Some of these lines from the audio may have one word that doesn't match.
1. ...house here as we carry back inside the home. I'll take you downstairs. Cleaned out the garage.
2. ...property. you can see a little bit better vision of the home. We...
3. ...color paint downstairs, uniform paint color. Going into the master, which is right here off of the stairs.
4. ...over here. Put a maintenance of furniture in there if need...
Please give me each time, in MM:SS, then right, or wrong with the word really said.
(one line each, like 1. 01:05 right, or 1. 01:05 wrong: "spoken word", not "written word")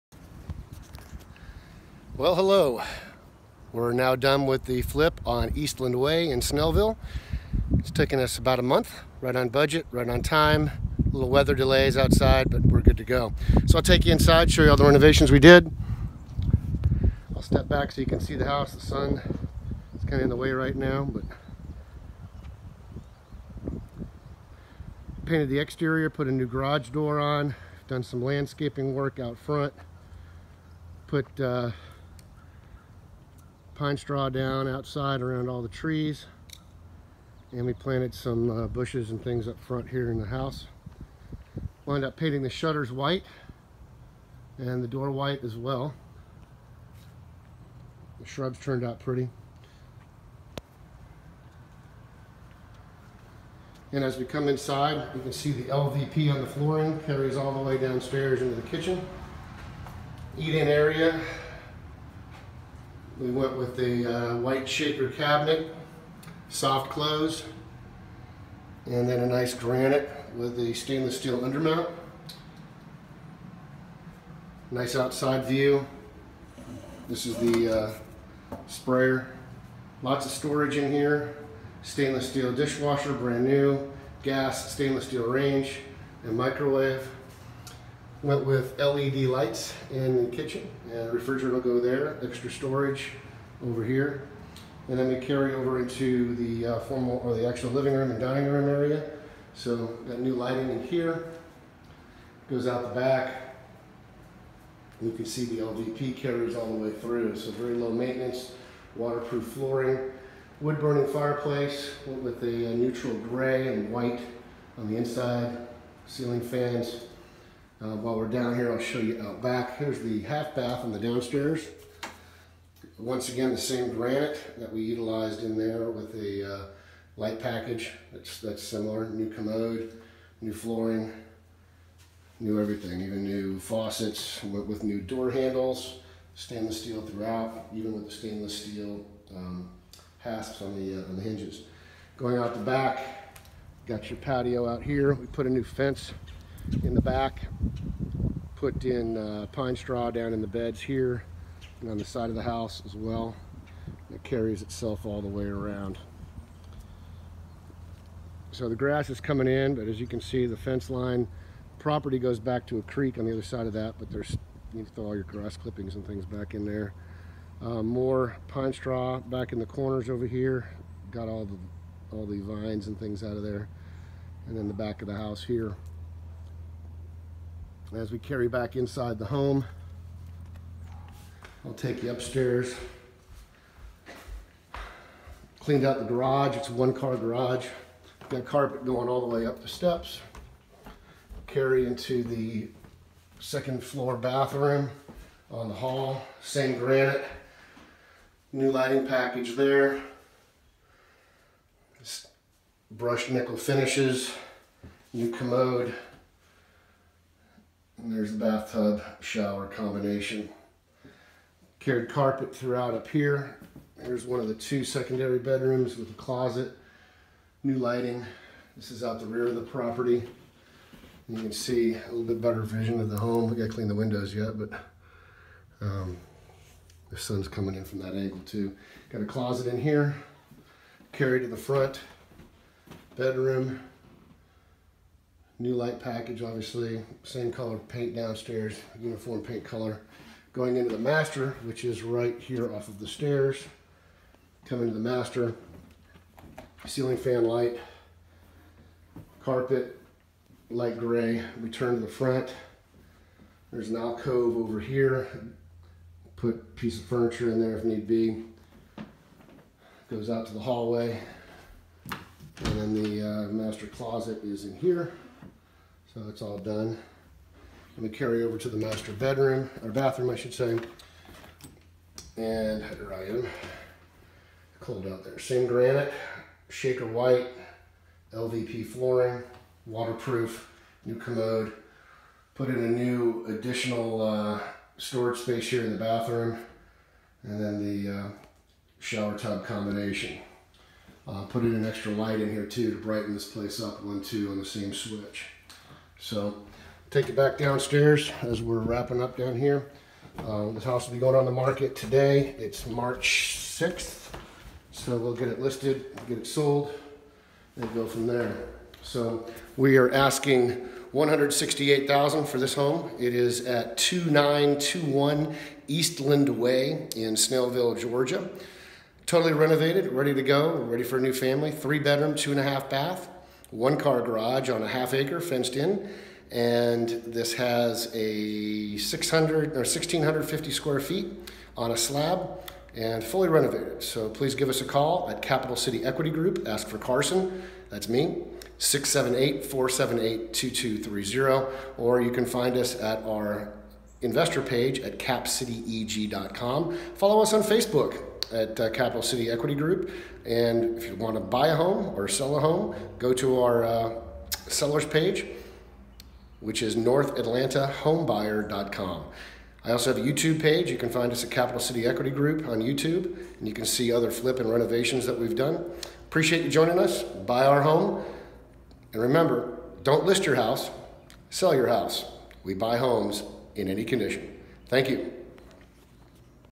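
1. 02:55 wrong: "upstairs", not "downstairs"
2. 03:39 right
3. 03:57 right
4. 04:14 wrong: "piece", not "maintenance".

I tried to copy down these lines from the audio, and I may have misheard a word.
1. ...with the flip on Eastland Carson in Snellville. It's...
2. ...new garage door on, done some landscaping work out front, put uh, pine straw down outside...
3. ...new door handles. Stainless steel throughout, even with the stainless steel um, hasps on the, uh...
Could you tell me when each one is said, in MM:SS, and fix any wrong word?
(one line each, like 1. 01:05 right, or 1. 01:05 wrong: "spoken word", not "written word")
1. 00:04 wrong: "Way", not "Carson"
2. 00:26 right
3. 02:14 right.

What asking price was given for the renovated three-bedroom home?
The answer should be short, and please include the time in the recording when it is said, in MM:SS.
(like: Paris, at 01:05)
$168,000, at 05:11.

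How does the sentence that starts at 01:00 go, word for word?
Eat-in area, we went with the uh, white shaker cabinet, soft close, and then a nice granite with the stainless steel undermount.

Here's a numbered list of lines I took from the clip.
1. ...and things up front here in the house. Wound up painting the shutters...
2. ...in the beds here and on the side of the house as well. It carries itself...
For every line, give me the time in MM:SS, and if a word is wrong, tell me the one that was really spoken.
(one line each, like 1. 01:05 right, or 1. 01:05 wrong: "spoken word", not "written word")
1. 00:39 right
2. 02:30 right.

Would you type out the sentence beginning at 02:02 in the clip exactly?
Once again, the same granite that we utilized in there with the uh, light package.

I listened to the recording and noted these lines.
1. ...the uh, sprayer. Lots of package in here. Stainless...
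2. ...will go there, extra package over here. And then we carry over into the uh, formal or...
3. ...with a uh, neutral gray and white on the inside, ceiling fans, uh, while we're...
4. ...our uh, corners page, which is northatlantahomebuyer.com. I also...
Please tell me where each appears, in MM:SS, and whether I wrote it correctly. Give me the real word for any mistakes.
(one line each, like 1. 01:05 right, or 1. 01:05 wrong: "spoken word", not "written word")
1. 01:17 wrong: "storage", not "package"
2. 01:31 wrong: "storage", not "package"
3. 01:52 right
4. 05:53 wrong: "sellers", not "corners".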